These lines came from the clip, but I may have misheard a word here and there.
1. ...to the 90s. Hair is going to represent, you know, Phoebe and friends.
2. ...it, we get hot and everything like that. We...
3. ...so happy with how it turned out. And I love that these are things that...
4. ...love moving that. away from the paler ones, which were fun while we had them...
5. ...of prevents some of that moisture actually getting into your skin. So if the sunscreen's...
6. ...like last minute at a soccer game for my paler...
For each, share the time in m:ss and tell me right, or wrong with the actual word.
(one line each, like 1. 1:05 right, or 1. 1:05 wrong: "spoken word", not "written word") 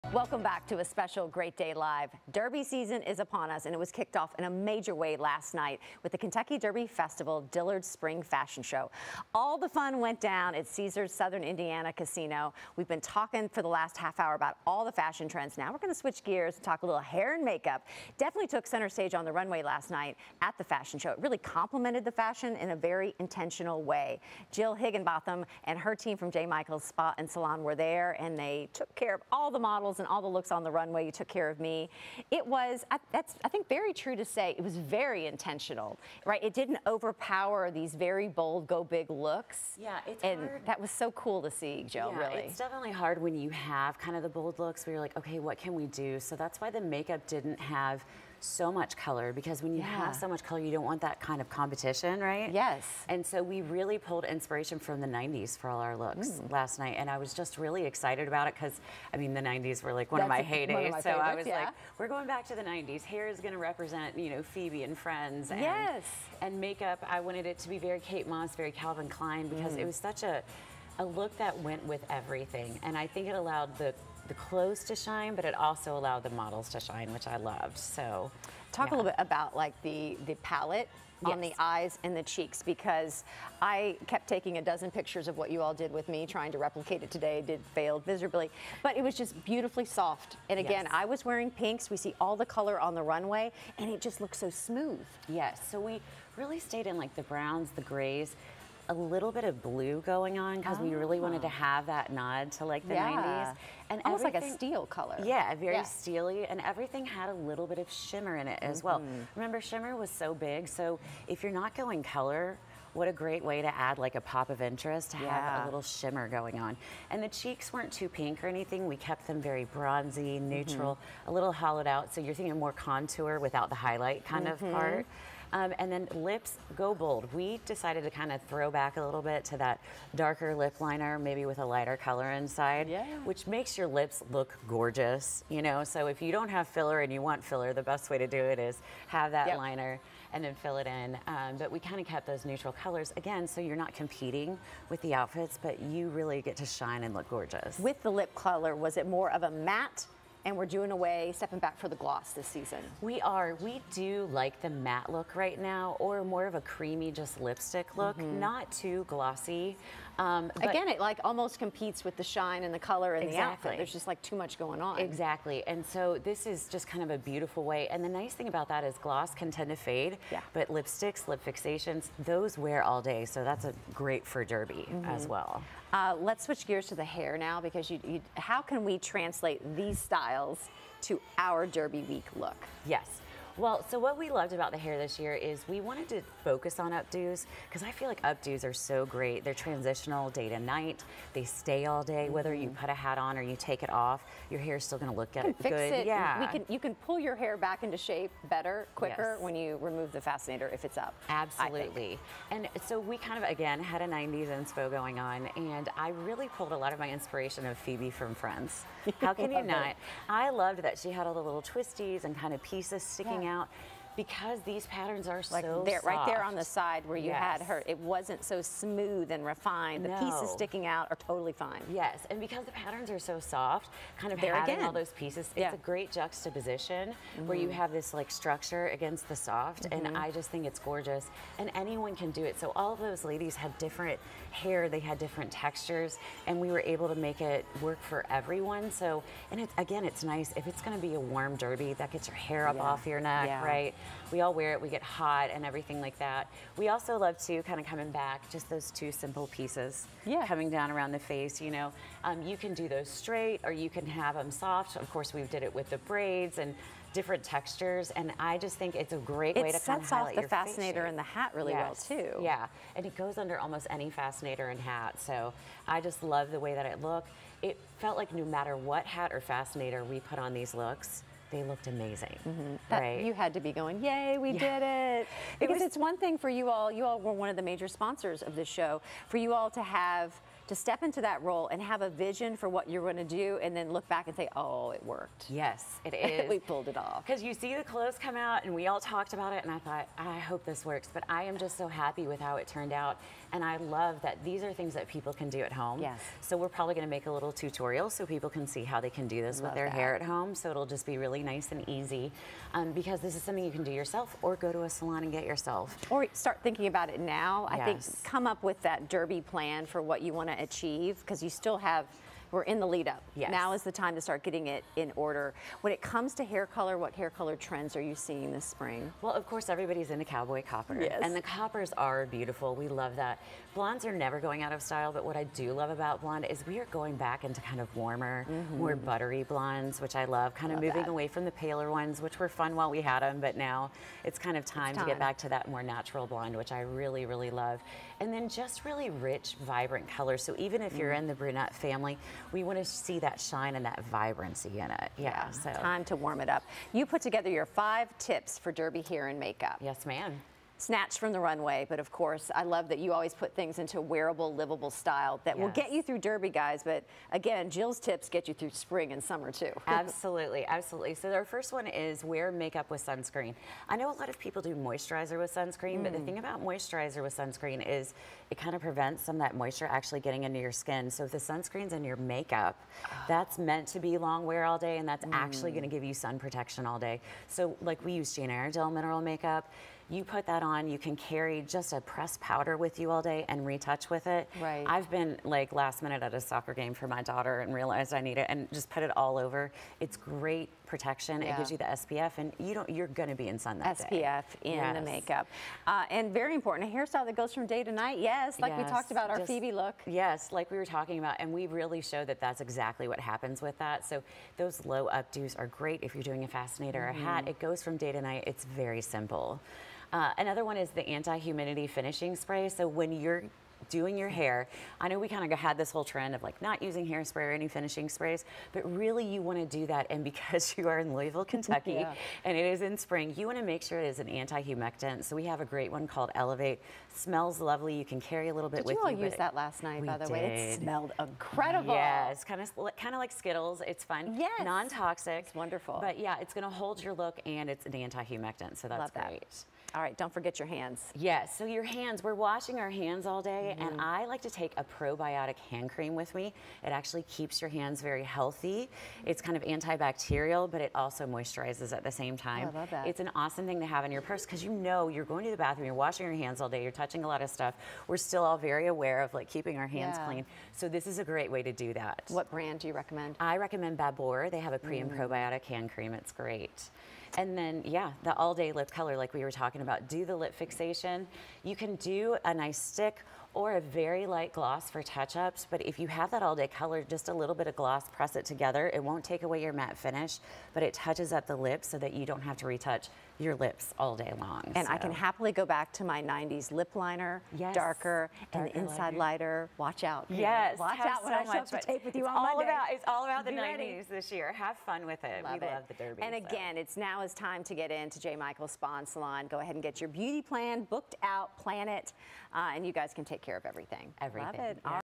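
1. 1:02 right
2. 4:04 right
3. 4:51 right
4. 5:30 right
5. 6:08 right
6. 6:25 wrong: "daughter", not "paler".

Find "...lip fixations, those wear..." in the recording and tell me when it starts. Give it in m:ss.
2:51.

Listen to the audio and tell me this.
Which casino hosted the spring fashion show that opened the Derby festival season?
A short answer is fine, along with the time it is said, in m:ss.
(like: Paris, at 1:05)
Caesars Southern Indiana, at 0:10.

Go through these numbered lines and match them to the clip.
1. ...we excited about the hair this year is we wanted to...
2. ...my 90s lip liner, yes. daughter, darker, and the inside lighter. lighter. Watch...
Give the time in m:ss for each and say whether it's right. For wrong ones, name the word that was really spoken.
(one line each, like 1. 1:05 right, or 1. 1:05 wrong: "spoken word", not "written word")
1. 3:04 wrong: "loved", not "excited"
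2. 8:06 wrong: "darker", not "daughter".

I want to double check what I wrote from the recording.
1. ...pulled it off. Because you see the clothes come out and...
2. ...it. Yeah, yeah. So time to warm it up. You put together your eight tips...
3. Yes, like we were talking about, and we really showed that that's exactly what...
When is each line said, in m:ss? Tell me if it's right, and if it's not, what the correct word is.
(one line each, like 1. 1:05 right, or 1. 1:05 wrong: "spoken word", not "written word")
1. 4:46 right
2. 5:44 wrong: "five", not "eight"
3. 6:40 right.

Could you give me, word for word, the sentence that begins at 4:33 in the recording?
You had to be going, yay, we yeah.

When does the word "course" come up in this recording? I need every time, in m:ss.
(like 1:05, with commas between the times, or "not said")
4:15, 5:19, 5:52.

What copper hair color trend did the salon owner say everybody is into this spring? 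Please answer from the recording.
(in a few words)
Cowboy copper.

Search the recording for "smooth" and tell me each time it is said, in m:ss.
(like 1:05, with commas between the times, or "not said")
1:34, 3:38.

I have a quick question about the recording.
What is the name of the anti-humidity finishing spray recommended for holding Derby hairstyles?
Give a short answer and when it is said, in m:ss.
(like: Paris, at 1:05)
Elevate, at 7:06.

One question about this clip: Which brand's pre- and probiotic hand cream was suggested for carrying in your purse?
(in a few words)
Babor.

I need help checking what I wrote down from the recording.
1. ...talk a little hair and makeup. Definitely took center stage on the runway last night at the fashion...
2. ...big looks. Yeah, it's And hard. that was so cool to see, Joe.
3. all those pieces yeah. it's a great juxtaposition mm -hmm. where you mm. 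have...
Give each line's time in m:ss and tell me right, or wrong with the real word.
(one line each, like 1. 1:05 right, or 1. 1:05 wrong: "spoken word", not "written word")
1. 0:16 right
2. 0:38 right
3. 3:44 right.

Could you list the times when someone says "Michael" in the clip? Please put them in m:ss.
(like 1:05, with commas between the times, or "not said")
0:26, 8:18.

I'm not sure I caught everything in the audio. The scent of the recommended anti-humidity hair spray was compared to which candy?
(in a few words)
Skittles.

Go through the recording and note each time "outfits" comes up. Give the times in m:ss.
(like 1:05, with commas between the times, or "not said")
2:25, 2:43.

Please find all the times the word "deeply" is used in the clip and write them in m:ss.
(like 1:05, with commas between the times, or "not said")
not said.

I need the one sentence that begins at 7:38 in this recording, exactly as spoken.
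We're still all very aware of like keeping our hands yeah.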